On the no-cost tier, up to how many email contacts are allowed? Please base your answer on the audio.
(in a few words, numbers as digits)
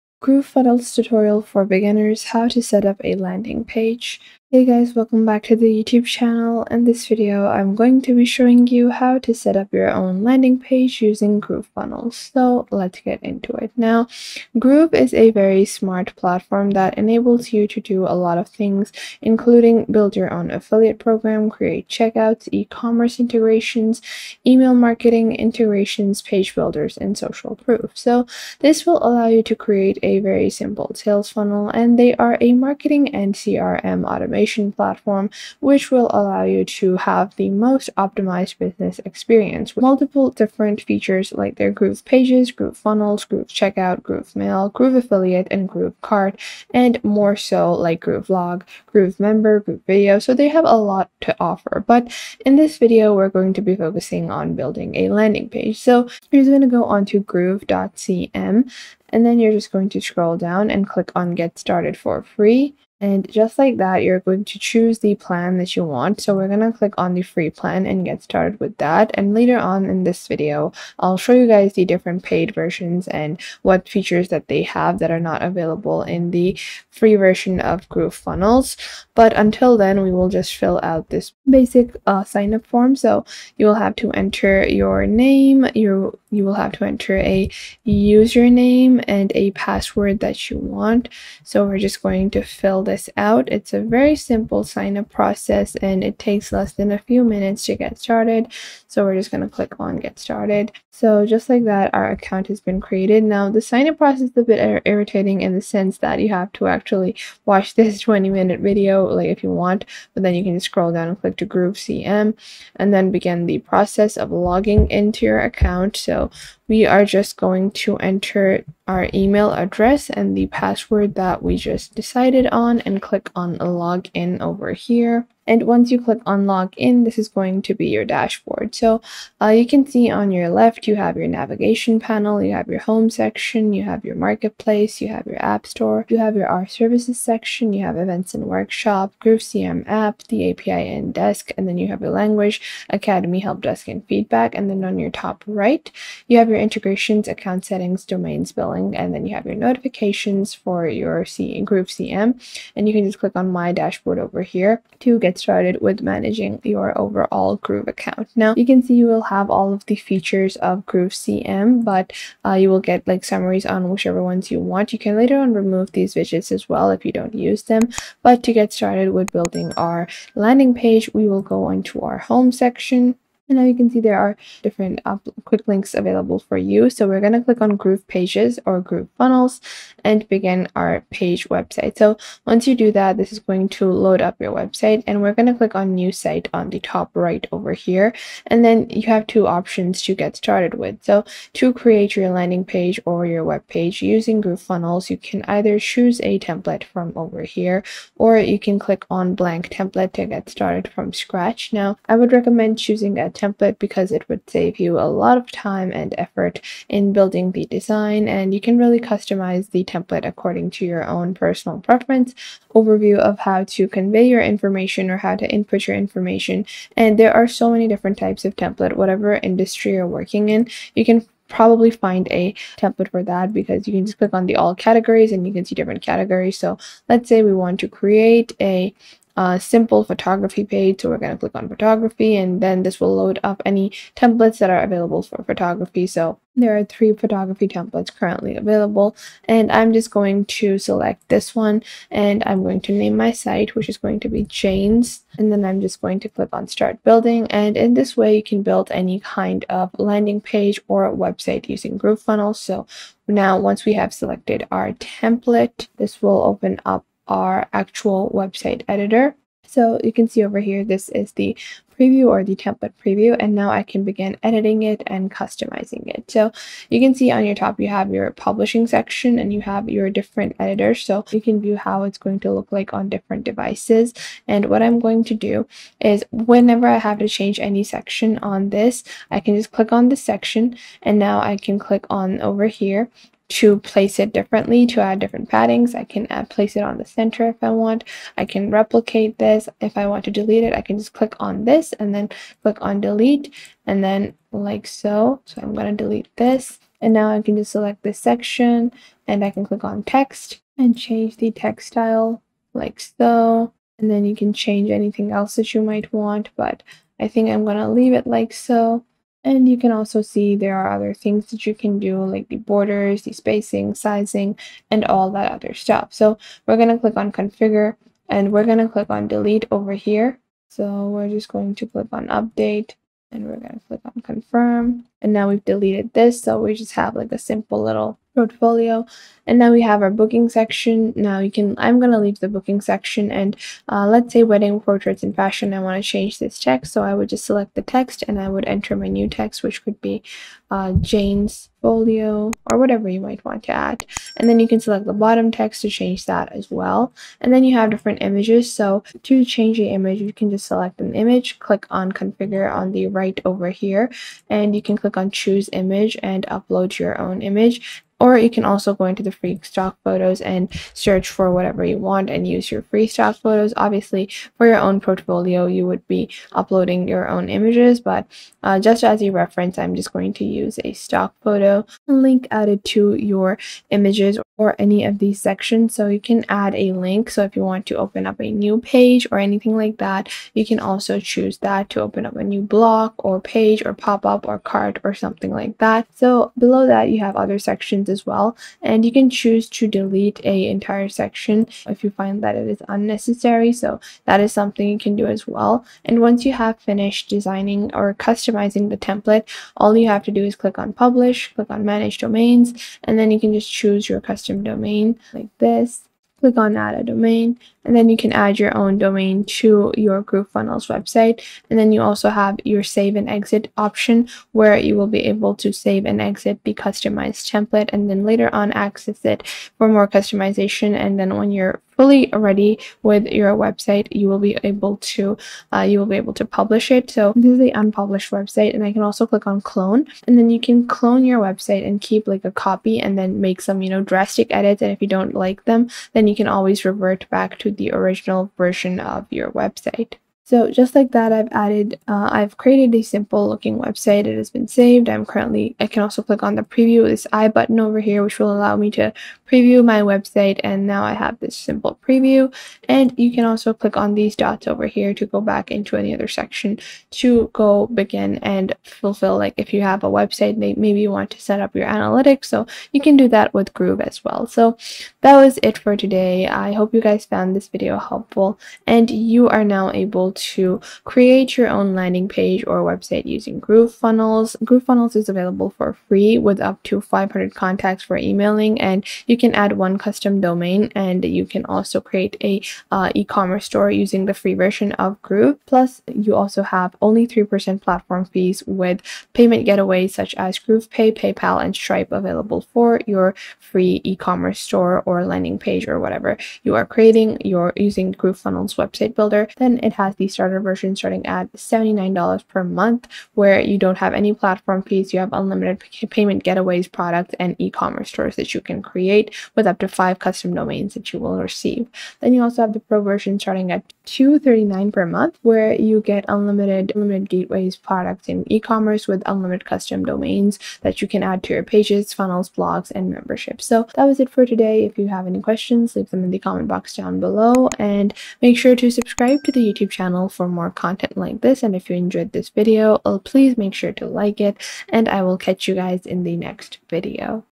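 500.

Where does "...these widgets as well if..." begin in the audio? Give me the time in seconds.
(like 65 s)
165 s.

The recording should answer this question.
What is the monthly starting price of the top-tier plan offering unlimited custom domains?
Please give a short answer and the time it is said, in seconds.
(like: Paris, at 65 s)
$239, at 514 s.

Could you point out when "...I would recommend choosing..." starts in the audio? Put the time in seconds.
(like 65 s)
202 s.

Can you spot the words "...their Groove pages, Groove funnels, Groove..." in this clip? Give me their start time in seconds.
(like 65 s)
41 s.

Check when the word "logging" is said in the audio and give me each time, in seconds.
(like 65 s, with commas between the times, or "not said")
114 s.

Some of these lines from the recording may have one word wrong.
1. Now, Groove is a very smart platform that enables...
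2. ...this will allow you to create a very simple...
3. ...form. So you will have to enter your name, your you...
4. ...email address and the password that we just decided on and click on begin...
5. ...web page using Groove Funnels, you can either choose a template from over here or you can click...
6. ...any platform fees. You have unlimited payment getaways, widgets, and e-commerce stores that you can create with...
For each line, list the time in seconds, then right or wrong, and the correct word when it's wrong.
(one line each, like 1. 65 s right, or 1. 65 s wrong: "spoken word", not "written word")
1. 13 s right
2. 28 s right
3. 82 s right
4. 119 s wrong: "login", not "begin"
5. 193 s right
6. 504 s wrong: "products", not "widgets".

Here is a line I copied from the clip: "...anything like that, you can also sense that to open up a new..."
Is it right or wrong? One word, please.
wrong.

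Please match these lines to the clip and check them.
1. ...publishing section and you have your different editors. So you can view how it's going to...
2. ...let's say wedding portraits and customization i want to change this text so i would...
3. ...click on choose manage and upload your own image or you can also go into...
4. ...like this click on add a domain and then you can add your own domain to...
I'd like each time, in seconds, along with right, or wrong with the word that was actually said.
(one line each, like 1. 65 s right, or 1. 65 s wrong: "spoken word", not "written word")
1. 268 s right
2. 334 s wrong: "fashion", not "customization"
3. 355 s wrong: "image", not "manage"
4. 405 s right.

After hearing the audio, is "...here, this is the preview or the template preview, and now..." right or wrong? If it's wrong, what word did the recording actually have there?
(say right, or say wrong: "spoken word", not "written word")
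right.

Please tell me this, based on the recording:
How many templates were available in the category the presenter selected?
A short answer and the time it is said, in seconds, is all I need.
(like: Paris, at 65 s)
3, at 236 s.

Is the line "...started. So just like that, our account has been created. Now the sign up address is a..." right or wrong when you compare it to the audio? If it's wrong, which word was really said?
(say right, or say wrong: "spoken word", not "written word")
wrong: "process", not "address".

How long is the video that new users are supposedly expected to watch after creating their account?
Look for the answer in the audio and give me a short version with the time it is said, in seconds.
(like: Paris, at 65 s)
20 minutes, at 108 s.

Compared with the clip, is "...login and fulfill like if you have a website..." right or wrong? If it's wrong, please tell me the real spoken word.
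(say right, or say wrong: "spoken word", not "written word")
wrong: "begin", not "login".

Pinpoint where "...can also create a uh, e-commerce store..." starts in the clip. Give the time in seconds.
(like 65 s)
481 s.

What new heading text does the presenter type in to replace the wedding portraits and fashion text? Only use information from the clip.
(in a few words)
Jane's folio.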